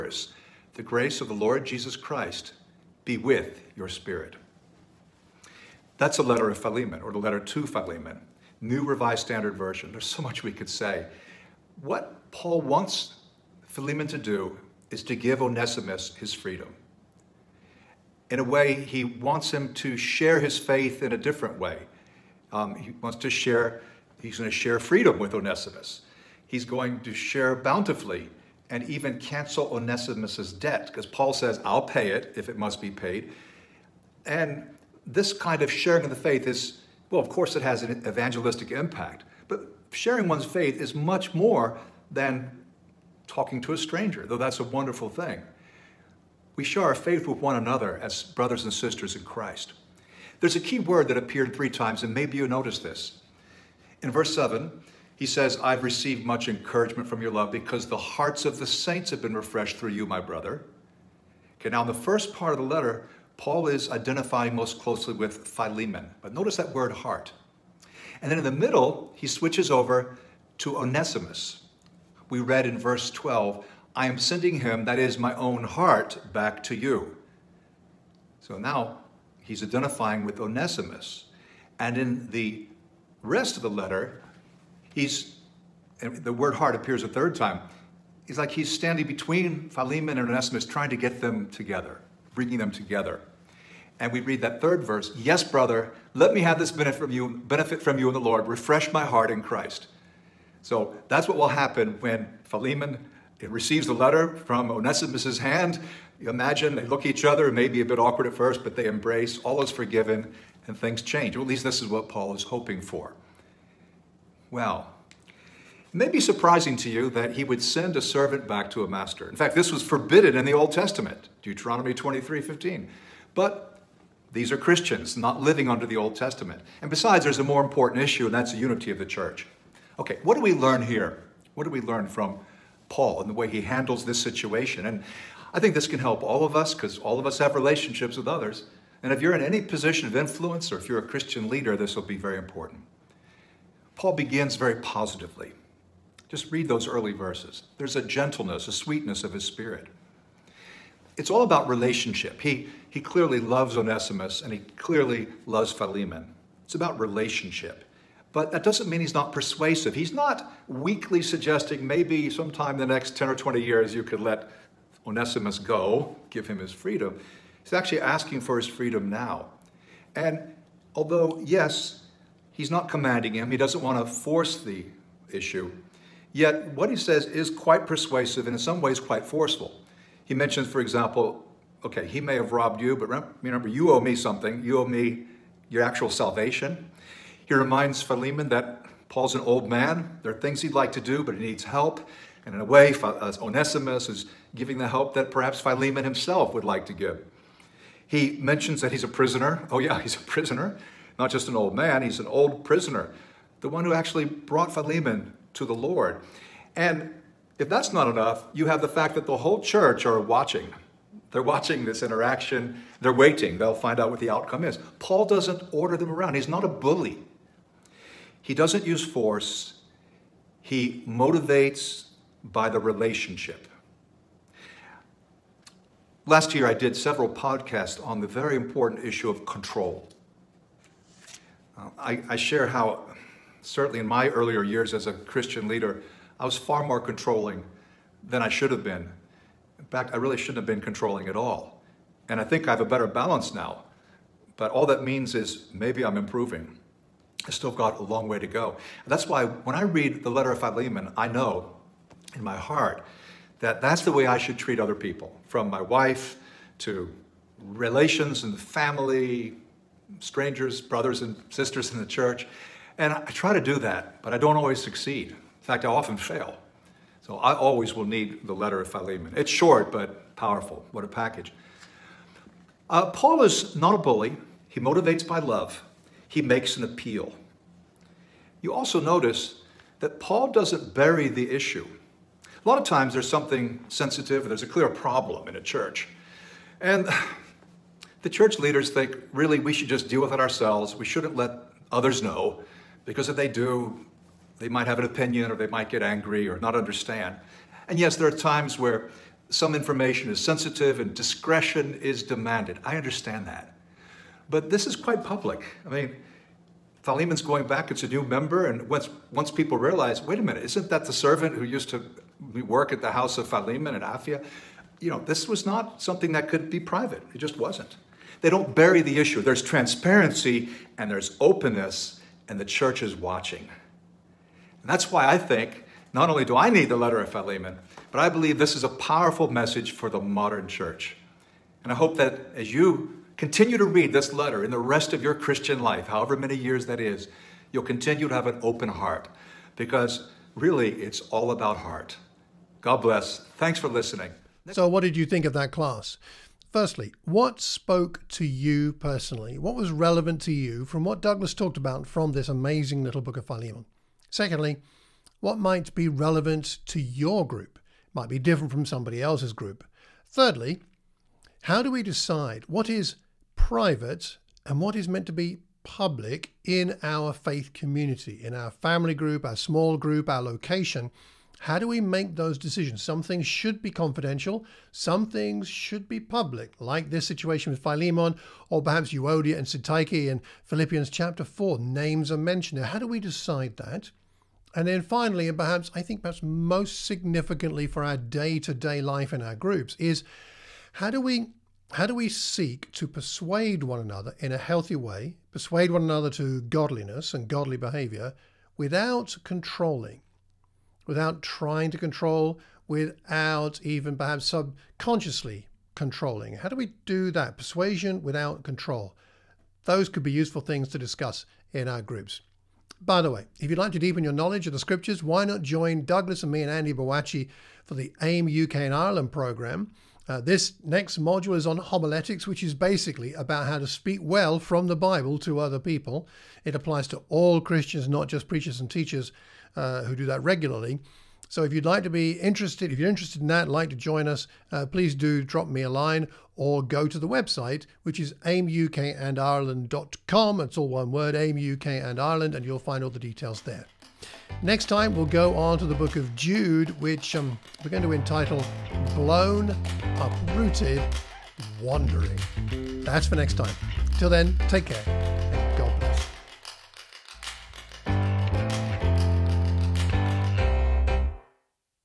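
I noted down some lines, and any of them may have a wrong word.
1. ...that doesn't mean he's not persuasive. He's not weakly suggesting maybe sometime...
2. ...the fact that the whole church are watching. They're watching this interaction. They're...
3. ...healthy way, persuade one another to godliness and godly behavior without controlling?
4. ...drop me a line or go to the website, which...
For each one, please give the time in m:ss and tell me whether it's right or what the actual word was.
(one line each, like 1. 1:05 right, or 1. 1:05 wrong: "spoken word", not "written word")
1. 2:38 right
2. 3:28 right
3. 6:34 right
4. 7:15 right.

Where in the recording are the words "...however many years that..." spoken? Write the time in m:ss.
5:36.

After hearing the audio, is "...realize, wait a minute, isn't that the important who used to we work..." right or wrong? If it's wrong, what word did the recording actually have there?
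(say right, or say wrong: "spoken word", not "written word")
wrong: "servant", not "important".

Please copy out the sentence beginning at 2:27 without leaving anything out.
There's a gentleness, a sweetness of his spirit.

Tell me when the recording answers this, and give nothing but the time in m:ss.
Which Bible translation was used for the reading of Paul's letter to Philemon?
0:08.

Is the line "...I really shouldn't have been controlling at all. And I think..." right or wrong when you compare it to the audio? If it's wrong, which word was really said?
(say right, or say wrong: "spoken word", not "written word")
right.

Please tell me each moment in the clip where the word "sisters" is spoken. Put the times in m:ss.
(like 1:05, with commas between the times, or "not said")
0:48, 4:21.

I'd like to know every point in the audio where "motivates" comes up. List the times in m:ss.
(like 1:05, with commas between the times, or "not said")
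3:41, 4:34.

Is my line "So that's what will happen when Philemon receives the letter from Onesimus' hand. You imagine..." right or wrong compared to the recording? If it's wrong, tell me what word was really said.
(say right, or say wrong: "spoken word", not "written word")
right.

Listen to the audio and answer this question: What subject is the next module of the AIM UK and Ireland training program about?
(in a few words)
homiletics.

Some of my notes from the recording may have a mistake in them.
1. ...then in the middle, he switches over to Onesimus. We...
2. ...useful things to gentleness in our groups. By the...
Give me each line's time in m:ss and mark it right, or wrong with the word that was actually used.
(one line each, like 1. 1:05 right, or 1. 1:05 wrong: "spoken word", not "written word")
1. 1:08 right
2. 6:50 wrong: "discuss", not "gentleness".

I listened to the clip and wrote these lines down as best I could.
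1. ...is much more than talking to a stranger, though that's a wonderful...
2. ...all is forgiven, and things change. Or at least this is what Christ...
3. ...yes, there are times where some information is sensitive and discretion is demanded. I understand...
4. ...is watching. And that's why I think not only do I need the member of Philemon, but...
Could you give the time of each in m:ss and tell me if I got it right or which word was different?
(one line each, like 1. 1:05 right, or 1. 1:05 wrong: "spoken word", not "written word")
1. 0:40 right
2. 1:49 wrong: "Paul", not "Christ"
3. 4:57 right
4. 5:23 wrong: "letter", not "member".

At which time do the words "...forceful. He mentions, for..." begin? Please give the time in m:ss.
2:59.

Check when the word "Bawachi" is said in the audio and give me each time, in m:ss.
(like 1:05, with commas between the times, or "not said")
6:56.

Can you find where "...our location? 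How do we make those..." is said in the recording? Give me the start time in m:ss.
6:10.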